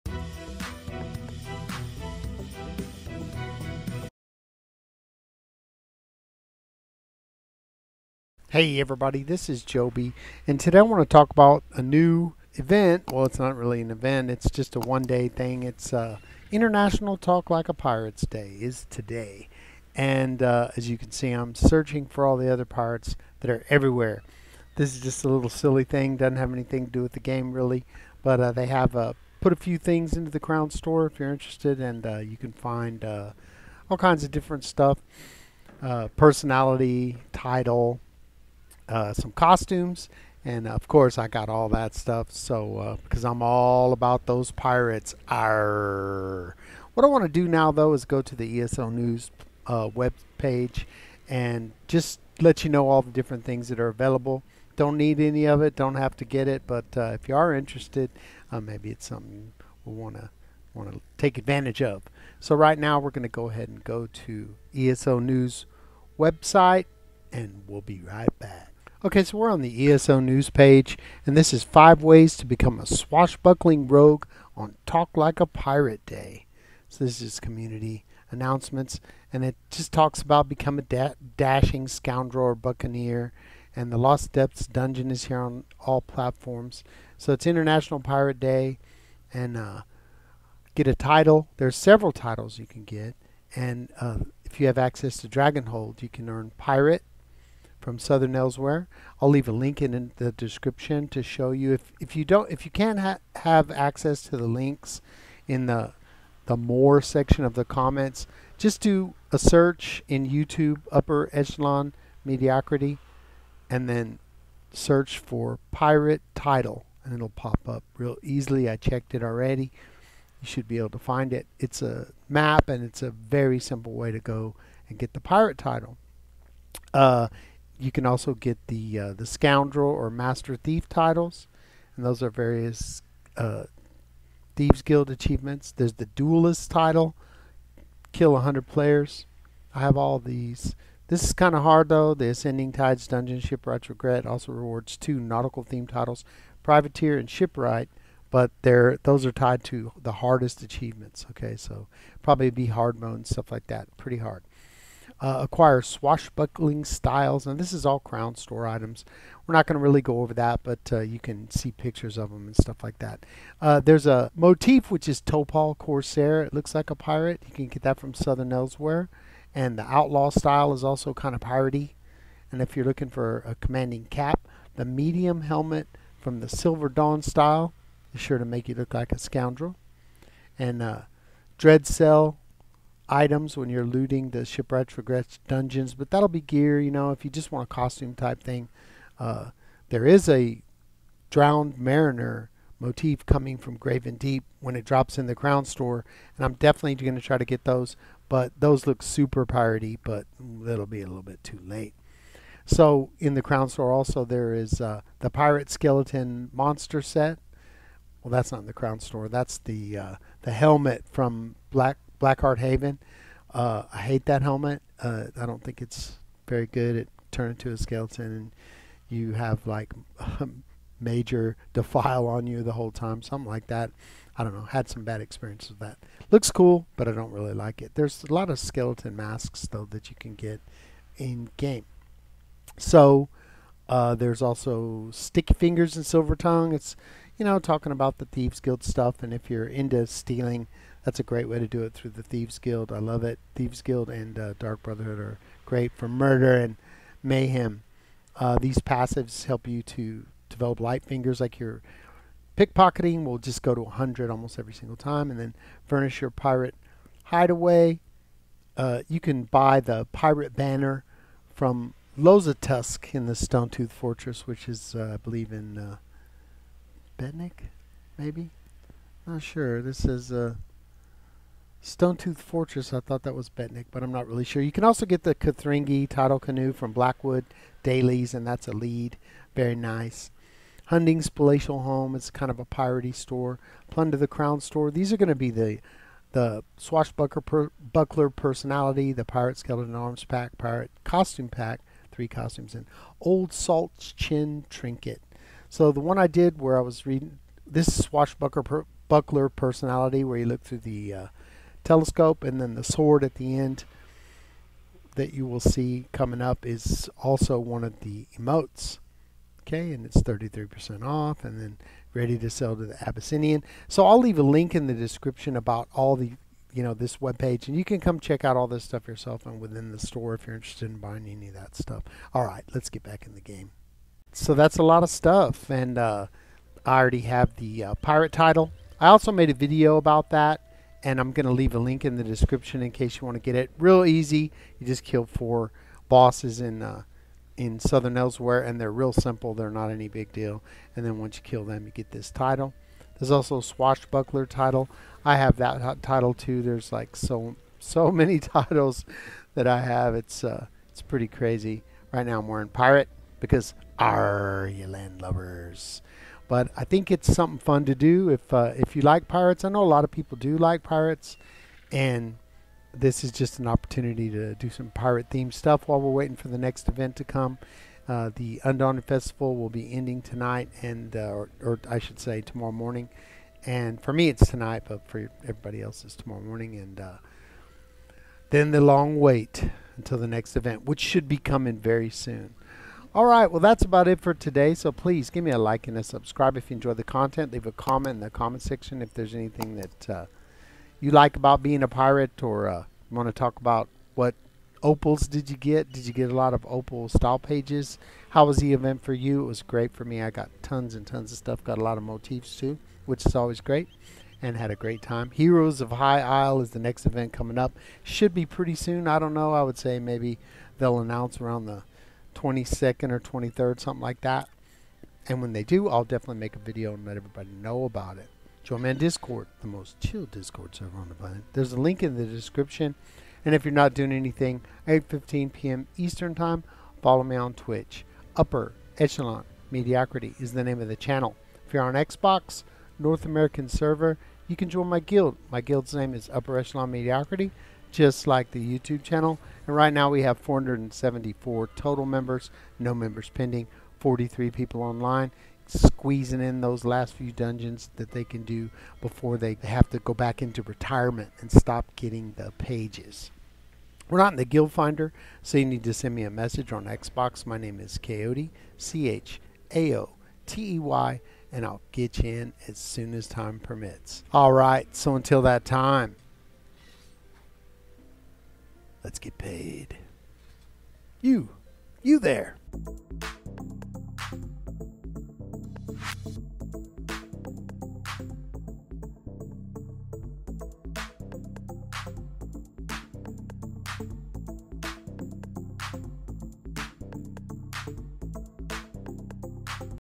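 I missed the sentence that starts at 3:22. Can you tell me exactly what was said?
So in the crown store also there is uh, the pirate skeleton monster set.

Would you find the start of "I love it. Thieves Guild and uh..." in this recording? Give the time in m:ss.
4:02.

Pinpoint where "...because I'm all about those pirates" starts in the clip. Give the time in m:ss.
0:43.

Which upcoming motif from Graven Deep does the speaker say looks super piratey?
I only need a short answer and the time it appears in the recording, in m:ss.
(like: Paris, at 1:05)
Drowned Mariner, at 3:11.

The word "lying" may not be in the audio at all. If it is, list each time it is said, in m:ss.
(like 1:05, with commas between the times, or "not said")
not said.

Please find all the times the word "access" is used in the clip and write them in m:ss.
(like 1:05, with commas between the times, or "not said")
1:34, 1:43.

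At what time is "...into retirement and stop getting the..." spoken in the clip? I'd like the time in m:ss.
7:30.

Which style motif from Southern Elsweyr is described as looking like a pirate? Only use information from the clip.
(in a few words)
Topal Corsair.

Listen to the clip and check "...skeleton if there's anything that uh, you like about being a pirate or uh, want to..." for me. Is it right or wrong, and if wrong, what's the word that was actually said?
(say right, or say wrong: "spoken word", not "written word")
wrong: "section", not "skeleton".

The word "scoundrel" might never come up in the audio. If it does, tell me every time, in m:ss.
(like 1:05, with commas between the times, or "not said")
1:21, 2:09, 2:59.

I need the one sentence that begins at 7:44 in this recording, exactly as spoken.
All right, so until that time, Let's get paid.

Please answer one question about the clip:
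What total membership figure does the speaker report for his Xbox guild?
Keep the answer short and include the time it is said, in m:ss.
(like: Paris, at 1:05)
474, at 7:20.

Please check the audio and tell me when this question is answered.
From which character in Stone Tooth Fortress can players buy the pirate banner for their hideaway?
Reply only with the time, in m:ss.
4:22.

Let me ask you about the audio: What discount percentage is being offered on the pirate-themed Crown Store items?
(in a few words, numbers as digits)
33%.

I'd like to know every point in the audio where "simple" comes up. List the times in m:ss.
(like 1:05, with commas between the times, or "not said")
2:03, 5:39.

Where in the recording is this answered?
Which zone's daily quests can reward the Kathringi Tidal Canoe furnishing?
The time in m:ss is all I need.
4:36.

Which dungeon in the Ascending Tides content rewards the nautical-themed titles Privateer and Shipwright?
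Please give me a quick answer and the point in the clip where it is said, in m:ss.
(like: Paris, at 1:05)
Shipwrights Regret, at 2:23.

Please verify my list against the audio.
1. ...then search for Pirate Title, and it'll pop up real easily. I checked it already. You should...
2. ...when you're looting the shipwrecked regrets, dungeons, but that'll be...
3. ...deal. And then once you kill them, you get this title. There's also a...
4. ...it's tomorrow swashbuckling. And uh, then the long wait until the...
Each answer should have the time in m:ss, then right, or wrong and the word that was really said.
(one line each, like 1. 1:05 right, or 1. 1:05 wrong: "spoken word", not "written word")
1. 1:53 right
2. 3:03 right
3. 5:40 right
4. 6:16 wrong: "morning", not "swashbuckling".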